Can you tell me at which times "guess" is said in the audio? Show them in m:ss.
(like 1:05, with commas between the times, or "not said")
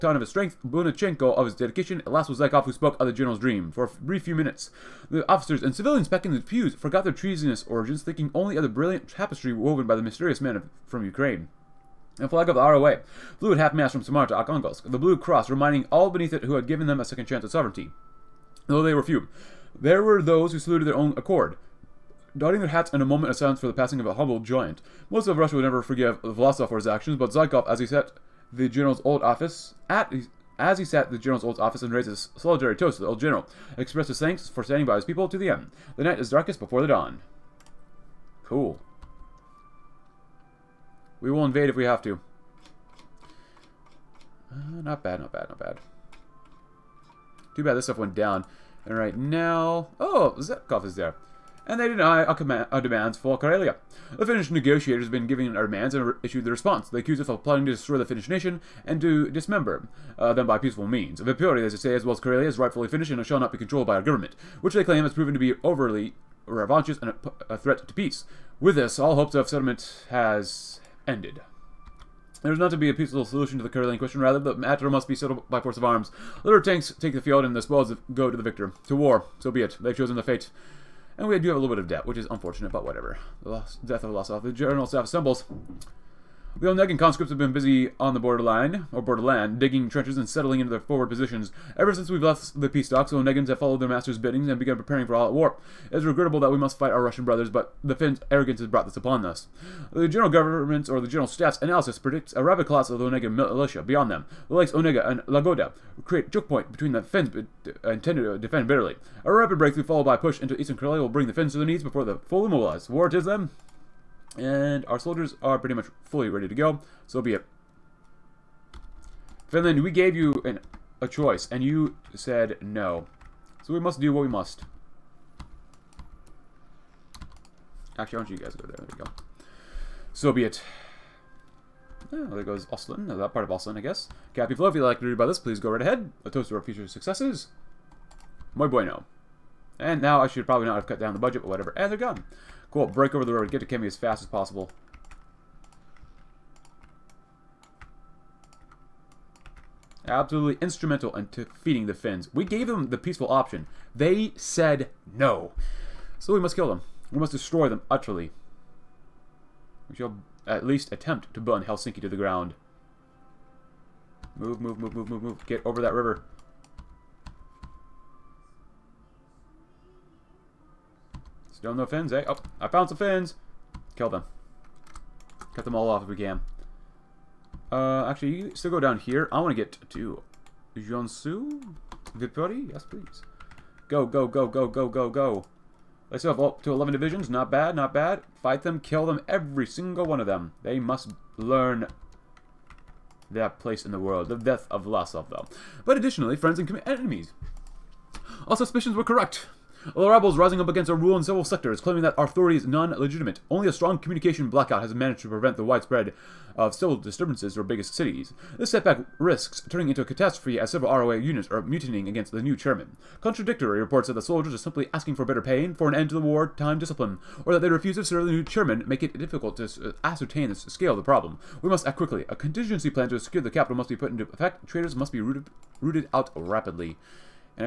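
2:13.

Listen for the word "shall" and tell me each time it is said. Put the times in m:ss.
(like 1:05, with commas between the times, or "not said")
1:03, 2:39.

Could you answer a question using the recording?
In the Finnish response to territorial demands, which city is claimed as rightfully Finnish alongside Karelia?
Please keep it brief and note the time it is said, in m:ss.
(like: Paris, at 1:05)
Vipuria, at 1:01.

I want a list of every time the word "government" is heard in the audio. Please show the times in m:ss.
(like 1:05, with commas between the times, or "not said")
1:04, 1:40.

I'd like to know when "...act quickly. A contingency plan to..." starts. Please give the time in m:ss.
3:41.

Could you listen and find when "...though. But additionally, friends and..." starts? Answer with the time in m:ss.
3:15.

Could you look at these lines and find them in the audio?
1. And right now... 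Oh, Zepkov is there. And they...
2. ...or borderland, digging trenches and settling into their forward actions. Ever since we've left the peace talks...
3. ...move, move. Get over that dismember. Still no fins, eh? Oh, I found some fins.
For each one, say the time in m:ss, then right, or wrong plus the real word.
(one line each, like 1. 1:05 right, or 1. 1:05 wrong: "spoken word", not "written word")
1. 0:48 right
2. 1:28 wrong: "positions", not "actions"
3. 2:45 wrong: "river", not "dismember".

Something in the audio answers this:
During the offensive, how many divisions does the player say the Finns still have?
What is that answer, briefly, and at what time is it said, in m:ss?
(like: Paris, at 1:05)
11, at 3:06.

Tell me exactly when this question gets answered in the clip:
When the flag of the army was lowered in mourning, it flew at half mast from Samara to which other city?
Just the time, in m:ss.
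0:14.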